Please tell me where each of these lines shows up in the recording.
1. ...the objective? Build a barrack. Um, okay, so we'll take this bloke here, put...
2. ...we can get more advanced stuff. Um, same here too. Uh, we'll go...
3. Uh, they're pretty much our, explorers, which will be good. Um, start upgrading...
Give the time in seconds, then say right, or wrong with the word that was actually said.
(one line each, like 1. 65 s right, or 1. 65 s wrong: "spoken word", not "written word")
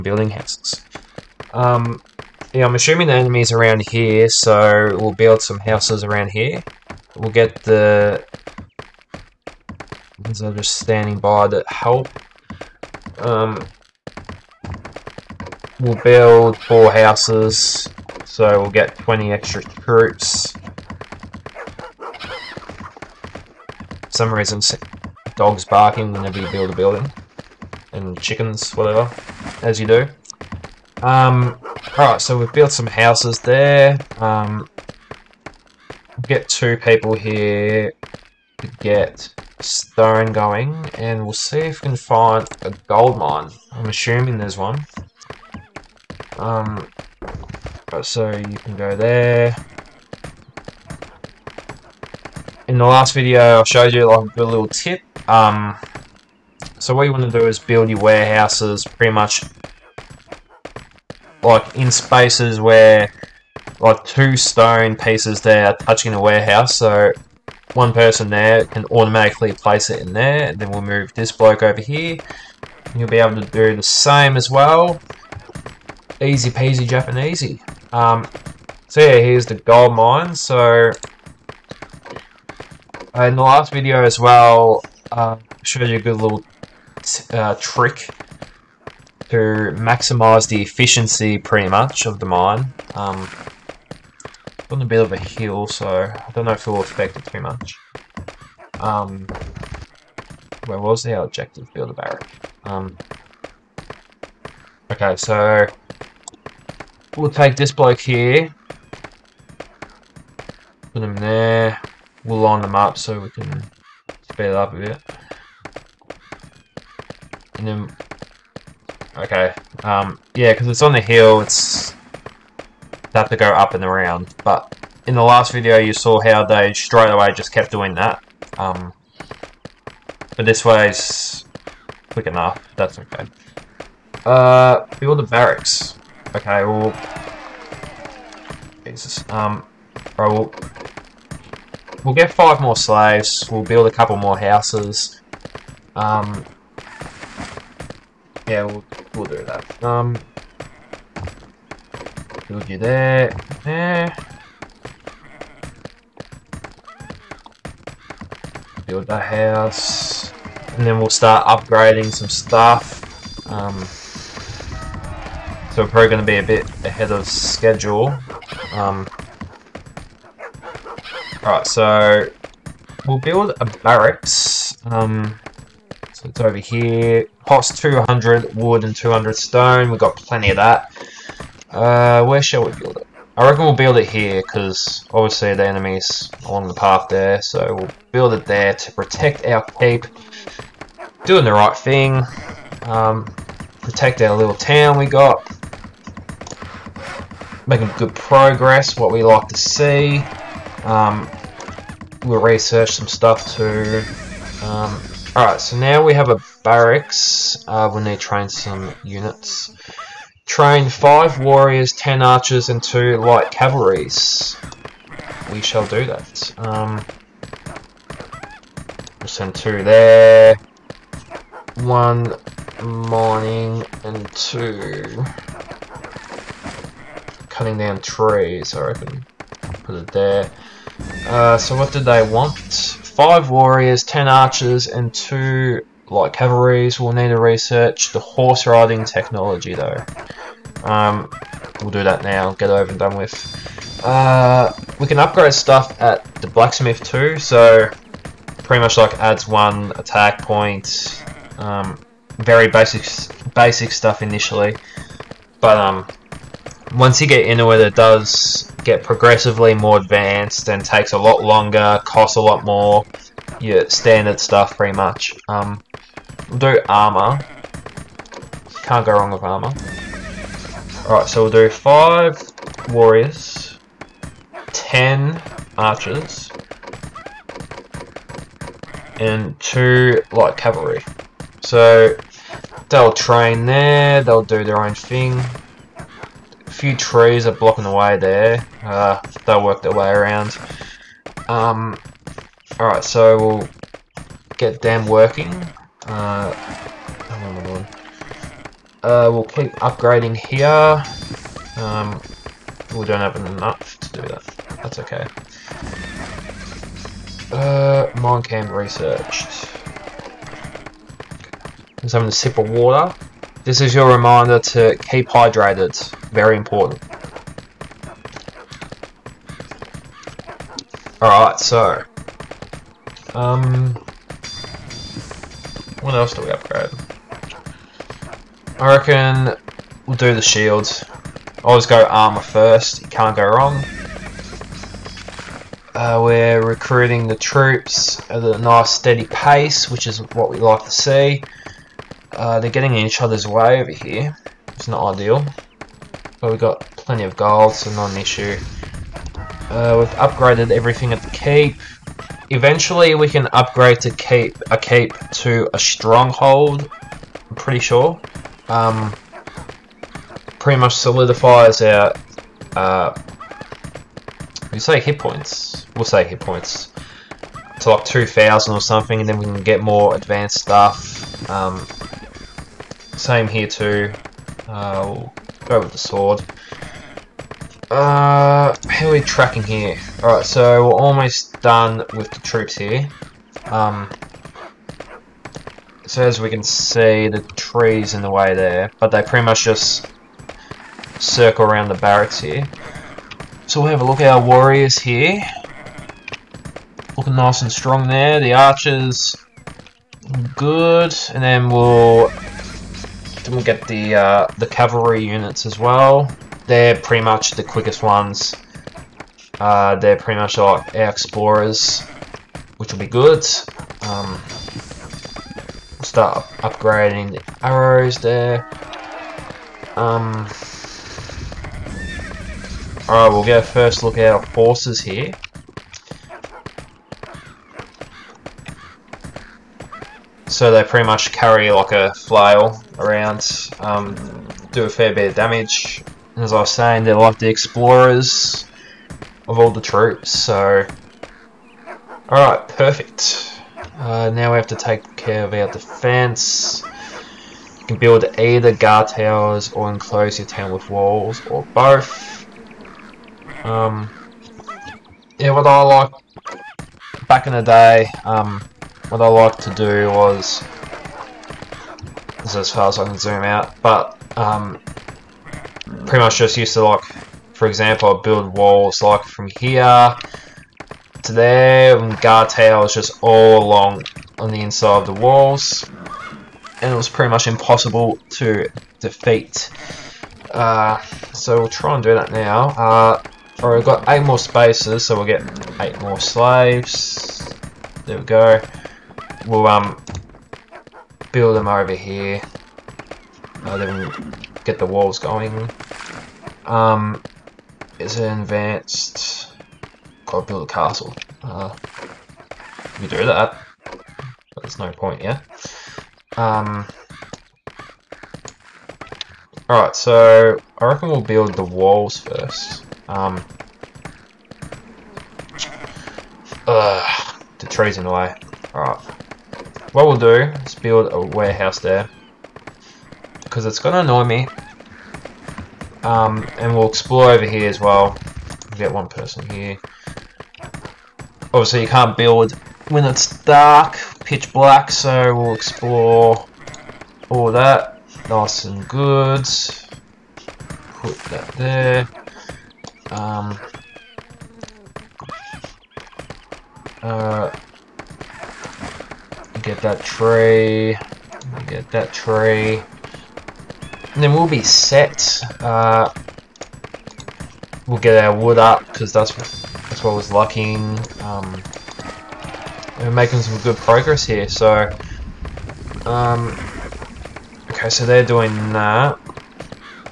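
1. 101 s right
2. 369 s right
3. 409 s right.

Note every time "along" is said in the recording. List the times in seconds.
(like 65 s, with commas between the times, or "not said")
186 s, 473 s.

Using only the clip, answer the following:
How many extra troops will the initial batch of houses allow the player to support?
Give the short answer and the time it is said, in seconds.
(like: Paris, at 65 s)
20, at 18 s.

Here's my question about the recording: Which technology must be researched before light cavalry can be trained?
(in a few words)
horse riding.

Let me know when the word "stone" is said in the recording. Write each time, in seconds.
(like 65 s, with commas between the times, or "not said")
39 s, 64 s, 179 s.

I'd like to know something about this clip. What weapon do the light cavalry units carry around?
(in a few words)
a flail.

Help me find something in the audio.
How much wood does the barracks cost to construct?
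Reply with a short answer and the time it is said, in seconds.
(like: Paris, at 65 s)
200, at 177 s.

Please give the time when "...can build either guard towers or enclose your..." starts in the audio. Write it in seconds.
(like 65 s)
447 s.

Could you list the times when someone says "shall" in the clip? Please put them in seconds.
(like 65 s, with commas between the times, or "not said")
182 s, 215 s.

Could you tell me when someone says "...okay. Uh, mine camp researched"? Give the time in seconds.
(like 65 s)
304 s.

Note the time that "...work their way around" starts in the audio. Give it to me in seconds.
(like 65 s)
289 s.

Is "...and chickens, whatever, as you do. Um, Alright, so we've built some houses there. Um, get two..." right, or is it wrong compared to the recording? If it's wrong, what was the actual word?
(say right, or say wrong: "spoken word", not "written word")
right.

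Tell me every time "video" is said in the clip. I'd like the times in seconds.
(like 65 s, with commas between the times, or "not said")
53 s, 83 s, 125 s.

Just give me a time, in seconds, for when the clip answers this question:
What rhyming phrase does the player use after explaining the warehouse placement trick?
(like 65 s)
76 s.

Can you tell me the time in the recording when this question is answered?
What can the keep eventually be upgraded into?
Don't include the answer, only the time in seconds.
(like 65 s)
355 s.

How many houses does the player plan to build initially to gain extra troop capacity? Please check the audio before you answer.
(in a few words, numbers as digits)
4.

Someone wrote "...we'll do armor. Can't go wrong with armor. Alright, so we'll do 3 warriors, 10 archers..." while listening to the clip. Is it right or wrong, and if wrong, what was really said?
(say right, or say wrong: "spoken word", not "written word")
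wrong: "5", not "3".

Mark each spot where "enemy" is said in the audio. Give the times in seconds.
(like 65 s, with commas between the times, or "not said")
3 s, 185 s.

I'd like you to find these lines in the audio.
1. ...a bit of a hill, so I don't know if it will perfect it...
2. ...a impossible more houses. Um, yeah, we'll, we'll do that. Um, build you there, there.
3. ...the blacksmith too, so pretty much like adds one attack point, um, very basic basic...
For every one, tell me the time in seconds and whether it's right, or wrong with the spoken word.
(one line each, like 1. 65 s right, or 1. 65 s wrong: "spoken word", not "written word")
1. 94 s wrong: "affect", not "perfect"
2. 143 s wrong: "couple", not "impossible"
3. 246 s right.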